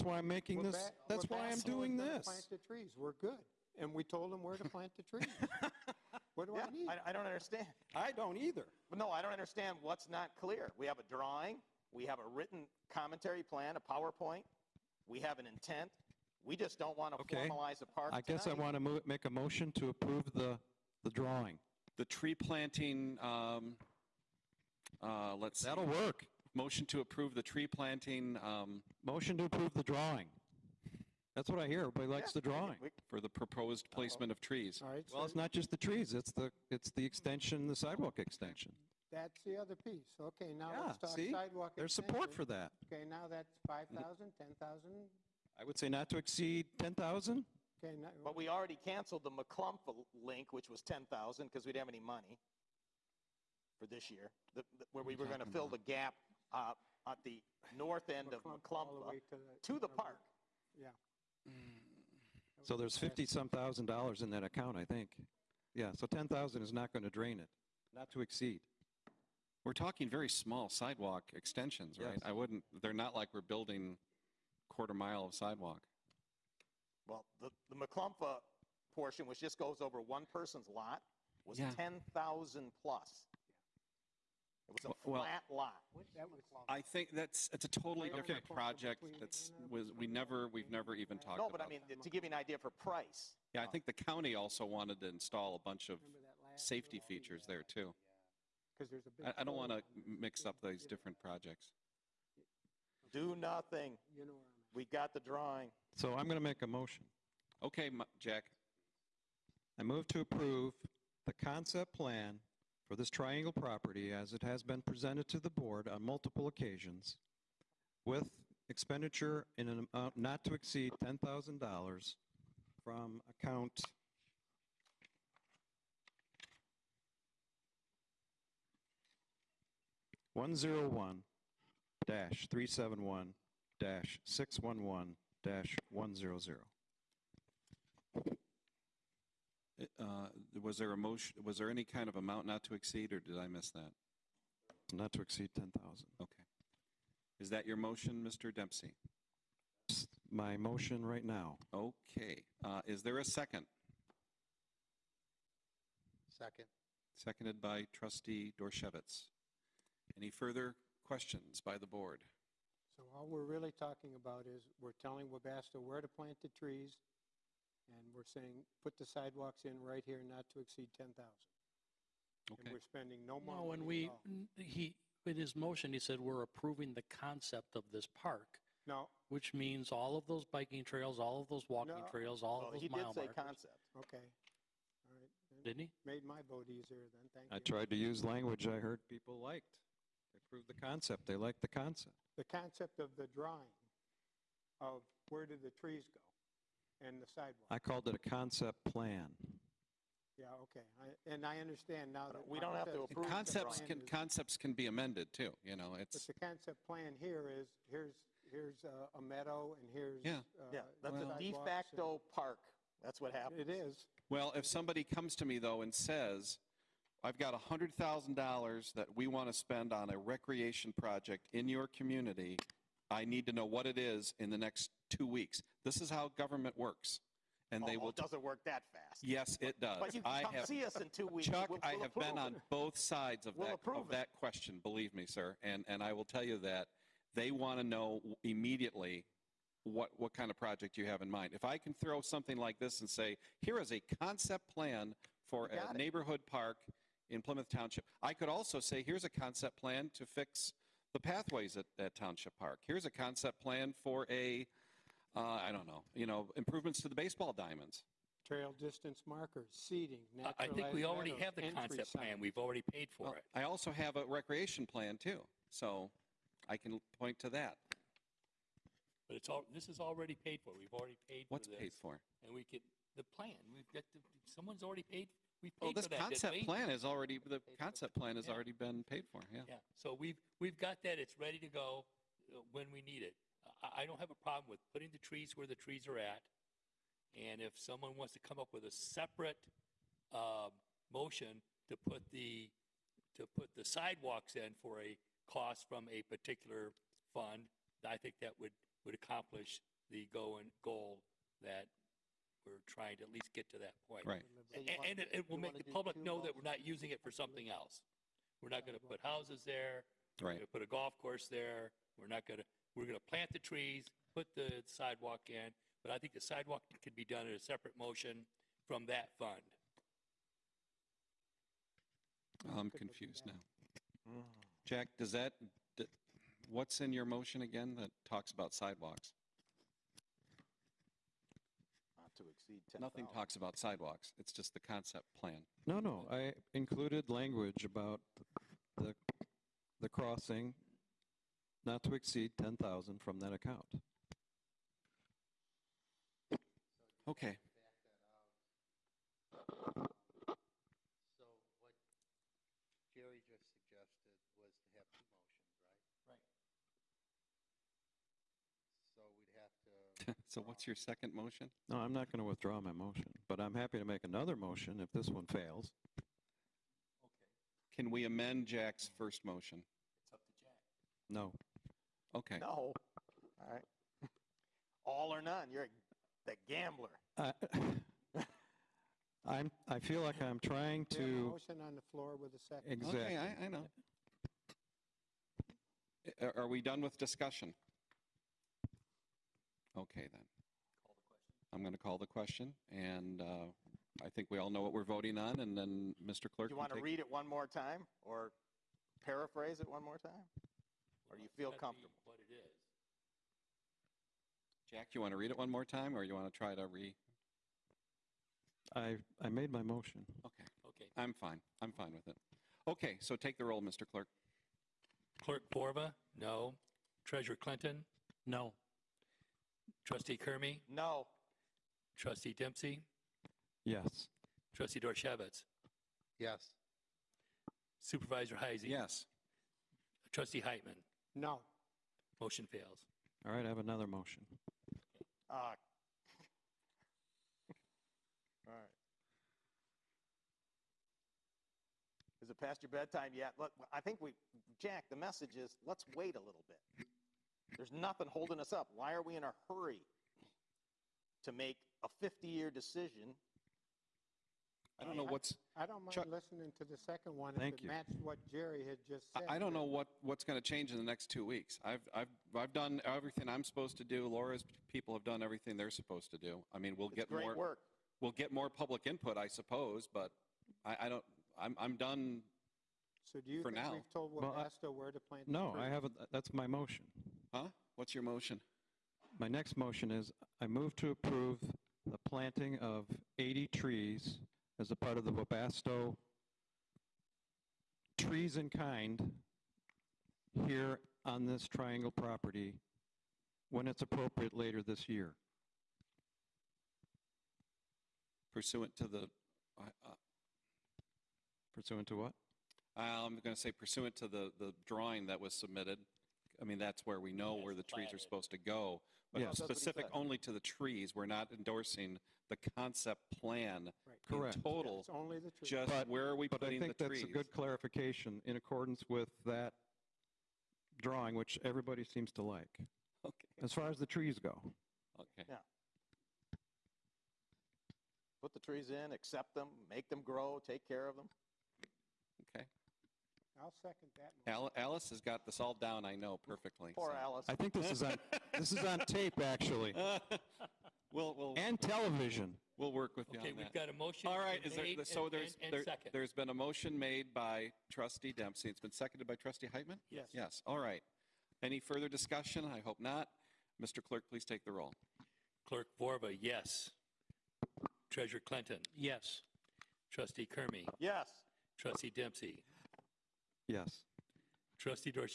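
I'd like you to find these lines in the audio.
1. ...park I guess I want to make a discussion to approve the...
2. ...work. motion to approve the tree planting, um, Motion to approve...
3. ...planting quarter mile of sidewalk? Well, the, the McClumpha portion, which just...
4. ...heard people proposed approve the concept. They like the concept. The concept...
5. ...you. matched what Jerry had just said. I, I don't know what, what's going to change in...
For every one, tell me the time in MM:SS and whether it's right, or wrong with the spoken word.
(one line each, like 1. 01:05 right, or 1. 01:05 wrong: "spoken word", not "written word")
1. 00:17 wrong: "motion", not "discussion"
2. 00:25 right
3. 01:13 wrong: "building", not "planting"
4. 03:08 wrong: "liked", not "proposed"
5. 07:37 right.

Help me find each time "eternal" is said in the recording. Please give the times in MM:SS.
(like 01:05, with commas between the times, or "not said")
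not said.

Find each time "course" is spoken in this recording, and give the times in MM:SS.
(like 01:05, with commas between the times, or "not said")
05:11.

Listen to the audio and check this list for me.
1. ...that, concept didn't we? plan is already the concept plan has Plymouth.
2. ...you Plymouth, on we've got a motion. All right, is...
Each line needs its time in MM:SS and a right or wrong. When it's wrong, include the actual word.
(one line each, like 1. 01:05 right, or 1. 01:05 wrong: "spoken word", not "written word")
1. 04:36 wrong: "Yeah", not "Plymouth"
2. 09:03 wrong: "Okay", not "Plymouth".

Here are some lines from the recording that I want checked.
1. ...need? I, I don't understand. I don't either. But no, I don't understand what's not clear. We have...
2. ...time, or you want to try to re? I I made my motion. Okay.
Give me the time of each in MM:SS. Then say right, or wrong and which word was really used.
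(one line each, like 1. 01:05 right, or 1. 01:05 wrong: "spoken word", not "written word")
1. 00:06 right
2. 06:45 right.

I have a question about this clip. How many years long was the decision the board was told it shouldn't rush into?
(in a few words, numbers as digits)
50.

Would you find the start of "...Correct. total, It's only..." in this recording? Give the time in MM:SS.
08:34.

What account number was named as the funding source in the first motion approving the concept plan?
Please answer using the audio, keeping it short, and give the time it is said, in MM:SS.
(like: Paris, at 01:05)
101-371-611100, at 02:10.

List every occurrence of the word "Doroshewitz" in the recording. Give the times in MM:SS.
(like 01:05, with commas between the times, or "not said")
02:38, 07:04.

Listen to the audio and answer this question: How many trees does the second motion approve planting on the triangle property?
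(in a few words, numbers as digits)
80.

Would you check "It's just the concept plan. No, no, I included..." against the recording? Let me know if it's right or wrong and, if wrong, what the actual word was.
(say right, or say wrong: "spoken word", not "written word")
right.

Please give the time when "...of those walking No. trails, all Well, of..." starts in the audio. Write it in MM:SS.
03:01.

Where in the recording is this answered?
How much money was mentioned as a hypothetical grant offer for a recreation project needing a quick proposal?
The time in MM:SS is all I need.
03:37.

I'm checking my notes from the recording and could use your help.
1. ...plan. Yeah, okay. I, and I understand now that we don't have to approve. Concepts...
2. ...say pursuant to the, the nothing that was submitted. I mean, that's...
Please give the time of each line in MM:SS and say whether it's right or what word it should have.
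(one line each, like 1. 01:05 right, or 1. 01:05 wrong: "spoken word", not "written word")
1. 03:18 right
2. 08:23 wrong: "drawing", not "nothing".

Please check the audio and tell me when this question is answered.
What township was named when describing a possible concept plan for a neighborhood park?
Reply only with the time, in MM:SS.
04:07.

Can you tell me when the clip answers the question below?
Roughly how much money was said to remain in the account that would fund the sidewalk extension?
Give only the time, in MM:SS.
01:02.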